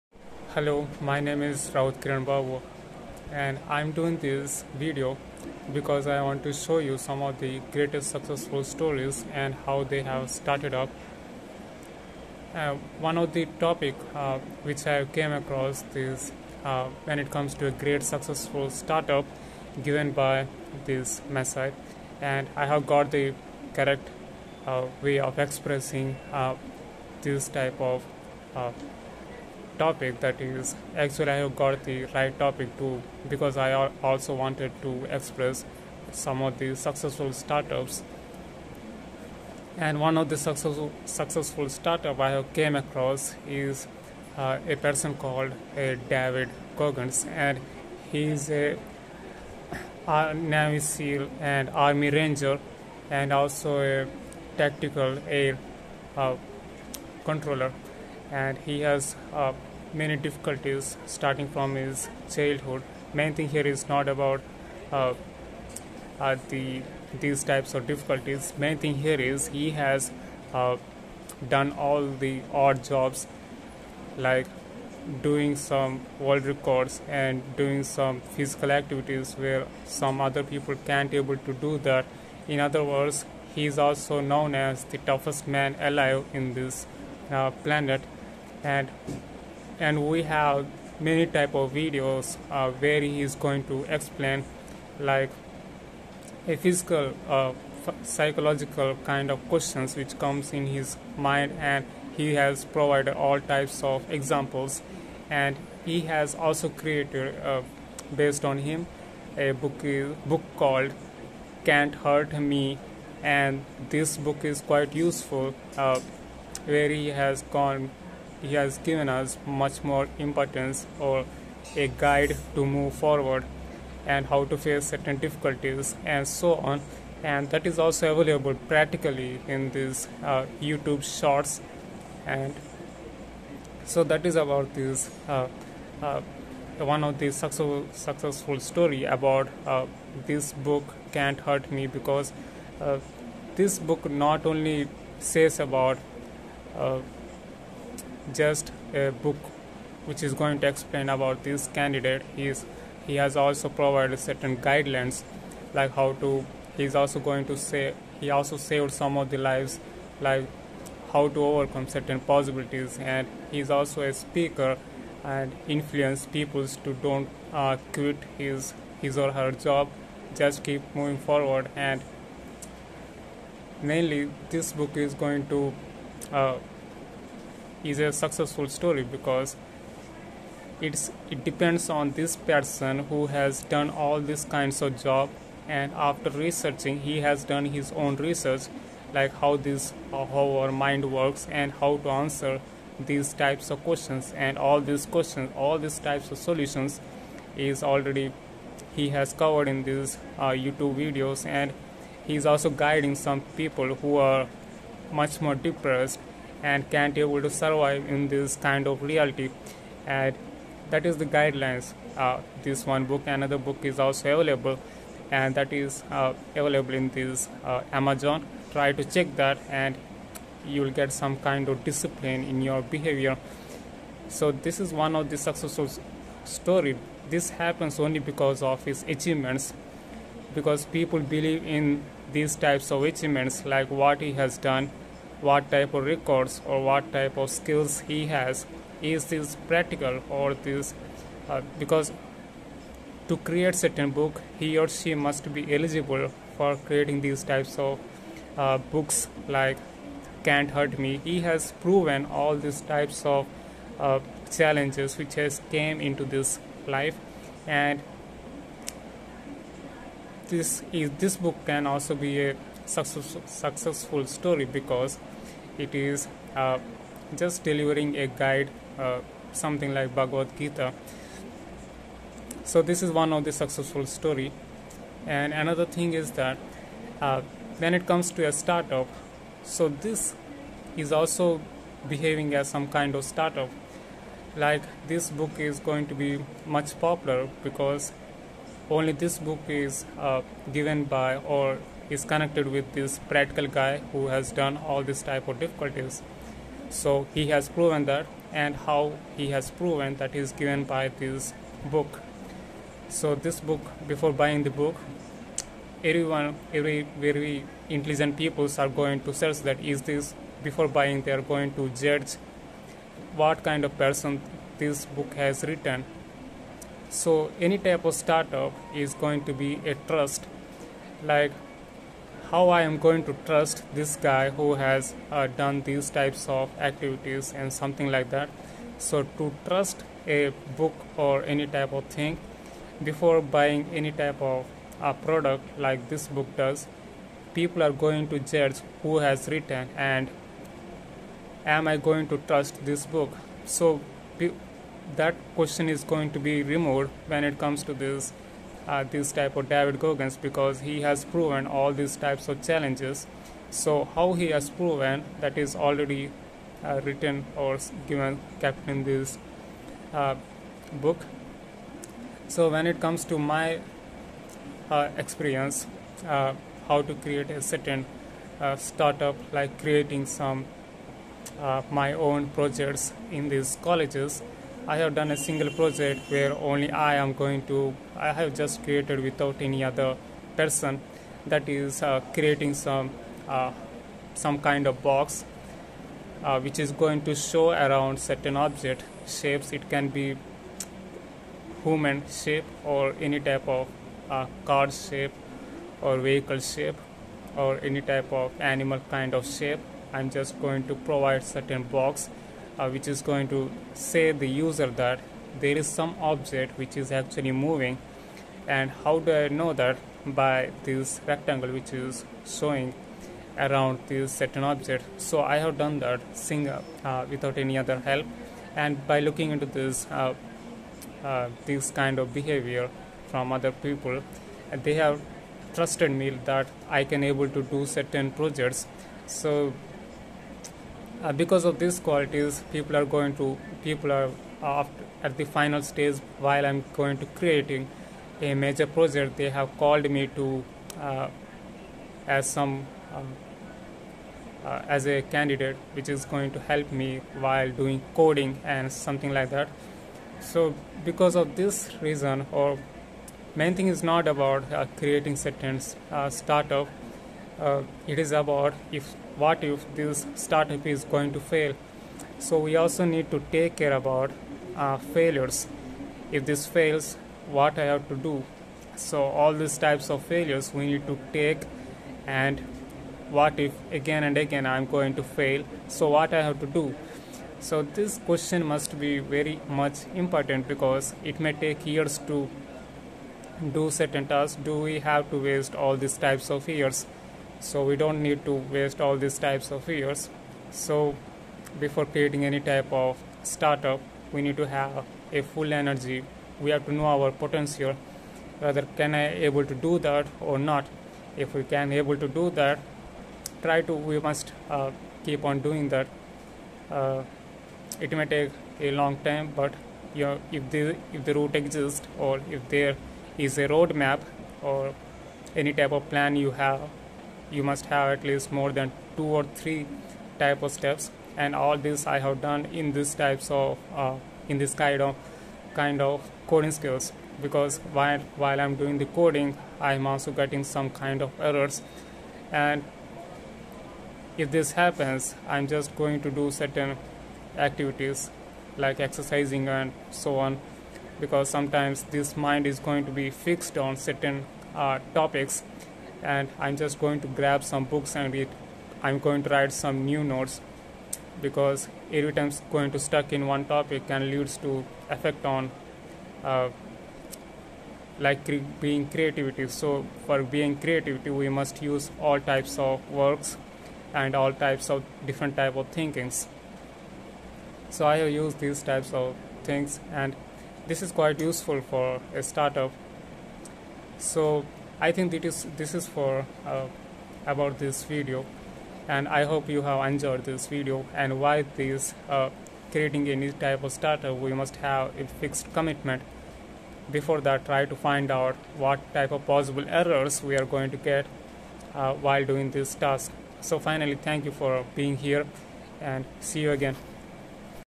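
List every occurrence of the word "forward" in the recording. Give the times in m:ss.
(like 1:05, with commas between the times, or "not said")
2:02, 2:51.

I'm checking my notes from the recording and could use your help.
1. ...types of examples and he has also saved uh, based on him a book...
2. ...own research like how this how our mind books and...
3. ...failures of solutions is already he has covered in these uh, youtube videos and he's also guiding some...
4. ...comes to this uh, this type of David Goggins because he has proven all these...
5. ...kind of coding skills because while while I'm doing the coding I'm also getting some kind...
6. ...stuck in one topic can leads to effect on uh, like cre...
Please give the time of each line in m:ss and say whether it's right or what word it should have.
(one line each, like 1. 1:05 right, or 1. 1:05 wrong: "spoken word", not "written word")
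1. 1:43 wrong: "created", not "saved"
2. 3:08 wrong: "works", not "books"
3. 3:15 wrong: "types", not "failures"
4. 5:47 right
5. 8:45 right
6. 9:12 right.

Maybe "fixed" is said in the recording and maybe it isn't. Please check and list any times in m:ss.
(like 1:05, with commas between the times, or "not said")
9:03, 9:45.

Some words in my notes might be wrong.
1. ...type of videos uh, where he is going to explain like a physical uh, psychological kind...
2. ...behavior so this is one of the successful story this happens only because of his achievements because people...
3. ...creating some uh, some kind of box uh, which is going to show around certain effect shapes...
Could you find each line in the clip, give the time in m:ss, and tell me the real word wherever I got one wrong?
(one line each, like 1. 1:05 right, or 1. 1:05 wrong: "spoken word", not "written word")
1. 1:31 right
2. 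3:42 right
3. 6:22 wrong: "object", not "effect".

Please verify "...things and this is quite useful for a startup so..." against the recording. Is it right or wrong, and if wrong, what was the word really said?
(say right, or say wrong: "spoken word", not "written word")
right.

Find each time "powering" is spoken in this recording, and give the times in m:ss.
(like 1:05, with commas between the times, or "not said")
not said.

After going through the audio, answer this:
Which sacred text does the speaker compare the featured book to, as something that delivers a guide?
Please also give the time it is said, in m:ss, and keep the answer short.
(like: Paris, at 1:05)
Bhagavad Gita, at 4:30.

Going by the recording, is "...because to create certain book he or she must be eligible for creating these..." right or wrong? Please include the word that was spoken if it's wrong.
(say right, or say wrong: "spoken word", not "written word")
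right.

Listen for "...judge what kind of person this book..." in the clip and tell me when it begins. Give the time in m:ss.
5:11.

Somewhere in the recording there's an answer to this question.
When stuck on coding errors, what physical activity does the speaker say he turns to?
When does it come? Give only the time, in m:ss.
8:58.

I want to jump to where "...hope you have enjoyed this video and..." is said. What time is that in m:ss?
9:39.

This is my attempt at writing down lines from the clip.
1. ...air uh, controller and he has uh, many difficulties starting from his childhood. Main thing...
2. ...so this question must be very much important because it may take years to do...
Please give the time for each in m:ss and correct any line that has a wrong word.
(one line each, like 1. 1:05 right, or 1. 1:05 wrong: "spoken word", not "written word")
1. 0:55 right
2. 7:57 right.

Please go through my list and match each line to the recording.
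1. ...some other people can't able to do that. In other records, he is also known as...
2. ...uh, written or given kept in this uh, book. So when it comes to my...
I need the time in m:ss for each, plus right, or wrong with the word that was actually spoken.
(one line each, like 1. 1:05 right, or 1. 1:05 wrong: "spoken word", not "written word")
1. 1:19 wrong: "words", not "records"
2. 5:56 right.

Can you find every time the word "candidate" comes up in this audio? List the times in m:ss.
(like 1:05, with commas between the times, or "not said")
2:31, 7:25.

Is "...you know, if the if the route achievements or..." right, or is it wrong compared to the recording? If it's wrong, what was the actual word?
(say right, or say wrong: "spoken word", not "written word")
wrong: "exists", not "achievements".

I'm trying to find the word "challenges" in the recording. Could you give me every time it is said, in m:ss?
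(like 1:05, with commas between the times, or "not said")
4:14, 5:52.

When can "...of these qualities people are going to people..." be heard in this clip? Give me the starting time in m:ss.
7:11.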